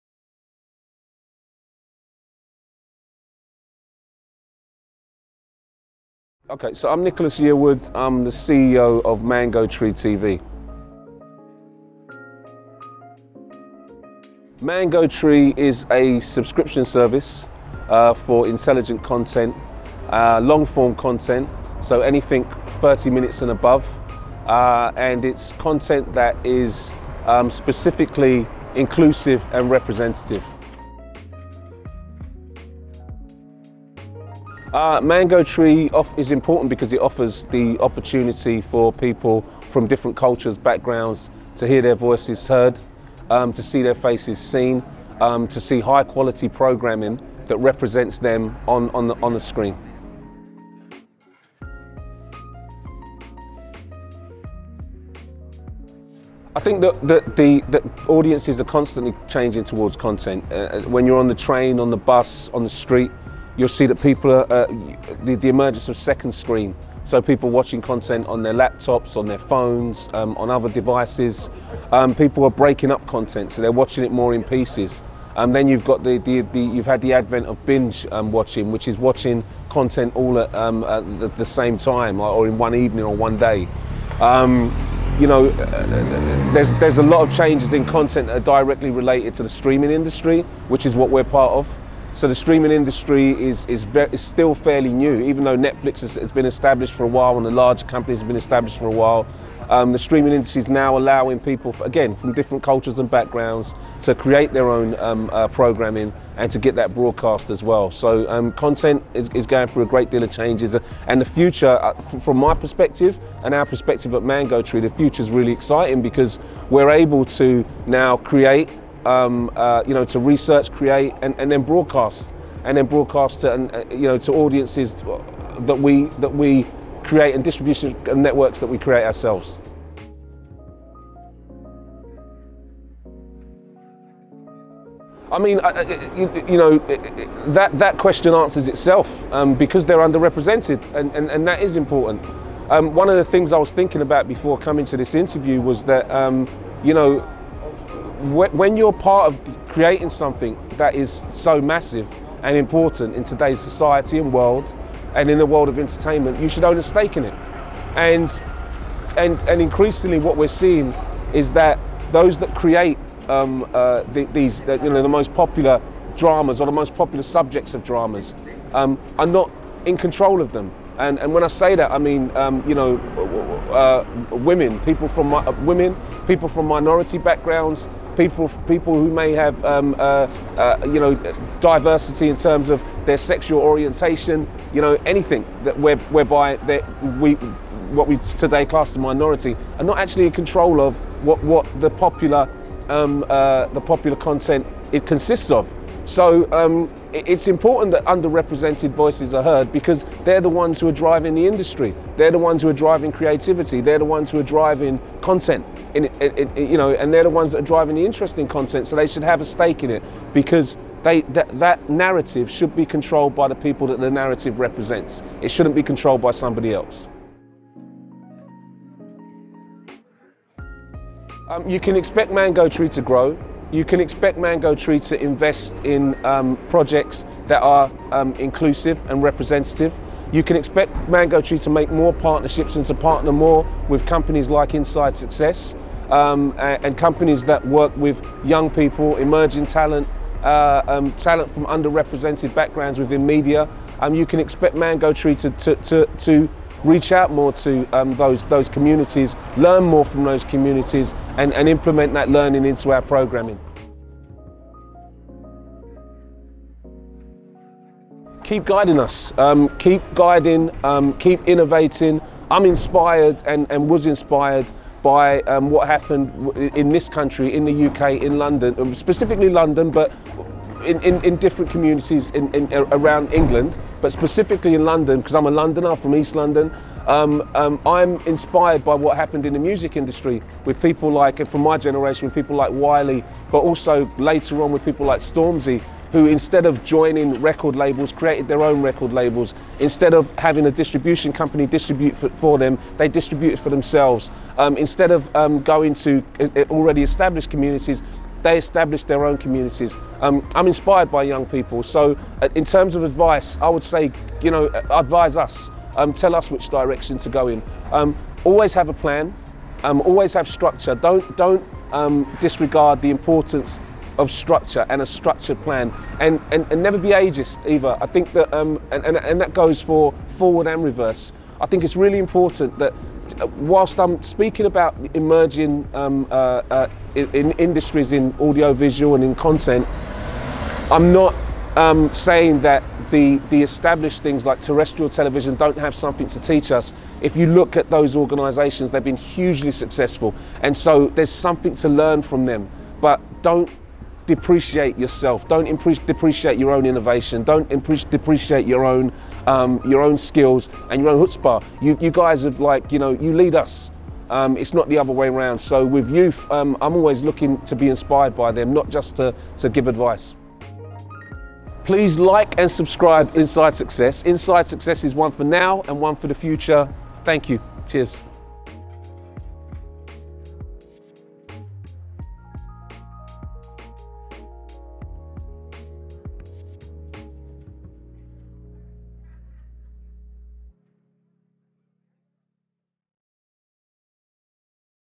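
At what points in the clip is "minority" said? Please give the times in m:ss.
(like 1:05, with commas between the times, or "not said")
2:56, 3:08.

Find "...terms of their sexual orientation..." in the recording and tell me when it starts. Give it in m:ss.
3:02.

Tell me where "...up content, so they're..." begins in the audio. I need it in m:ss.
1:12.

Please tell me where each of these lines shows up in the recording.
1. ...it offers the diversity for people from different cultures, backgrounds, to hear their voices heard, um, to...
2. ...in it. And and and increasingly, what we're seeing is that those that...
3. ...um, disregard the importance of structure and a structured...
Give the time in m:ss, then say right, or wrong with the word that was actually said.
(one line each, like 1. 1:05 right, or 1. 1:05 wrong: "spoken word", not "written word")
1. 0:36 wrong: "opportunity", not "diversity"
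2. 2:37 right
3. 5:11 right.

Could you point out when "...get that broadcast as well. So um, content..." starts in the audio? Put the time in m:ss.
1:46.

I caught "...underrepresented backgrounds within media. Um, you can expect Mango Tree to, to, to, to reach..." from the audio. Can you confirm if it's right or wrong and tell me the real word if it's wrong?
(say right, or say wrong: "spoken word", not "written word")
right.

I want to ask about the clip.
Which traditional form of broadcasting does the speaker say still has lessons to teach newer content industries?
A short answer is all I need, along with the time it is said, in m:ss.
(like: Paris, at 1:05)
terrestrial television, at 5:34.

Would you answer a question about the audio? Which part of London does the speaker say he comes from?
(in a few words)
East London.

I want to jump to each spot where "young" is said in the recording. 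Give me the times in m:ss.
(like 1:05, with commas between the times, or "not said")
3:58, 5:01.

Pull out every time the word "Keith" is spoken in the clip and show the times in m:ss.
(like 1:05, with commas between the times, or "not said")
not said.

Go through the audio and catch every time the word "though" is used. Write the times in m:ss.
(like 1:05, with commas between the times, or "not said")
1:35.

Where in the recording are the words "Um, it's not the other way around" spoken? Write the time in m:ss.
5:54.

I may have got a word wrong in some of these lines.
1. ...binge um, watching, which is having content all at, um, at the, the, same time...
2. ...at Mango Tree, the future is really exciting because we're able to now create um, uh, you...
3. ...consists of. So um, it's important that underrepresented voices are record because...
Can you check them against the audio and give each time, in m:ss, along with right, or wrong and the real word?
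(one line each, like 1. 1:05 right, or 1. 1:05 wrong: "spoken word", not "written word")
1. 1:17 wrong: "watching", not "having"
2. 1:54 right
3. 3:15 wrong: "heard", not "record".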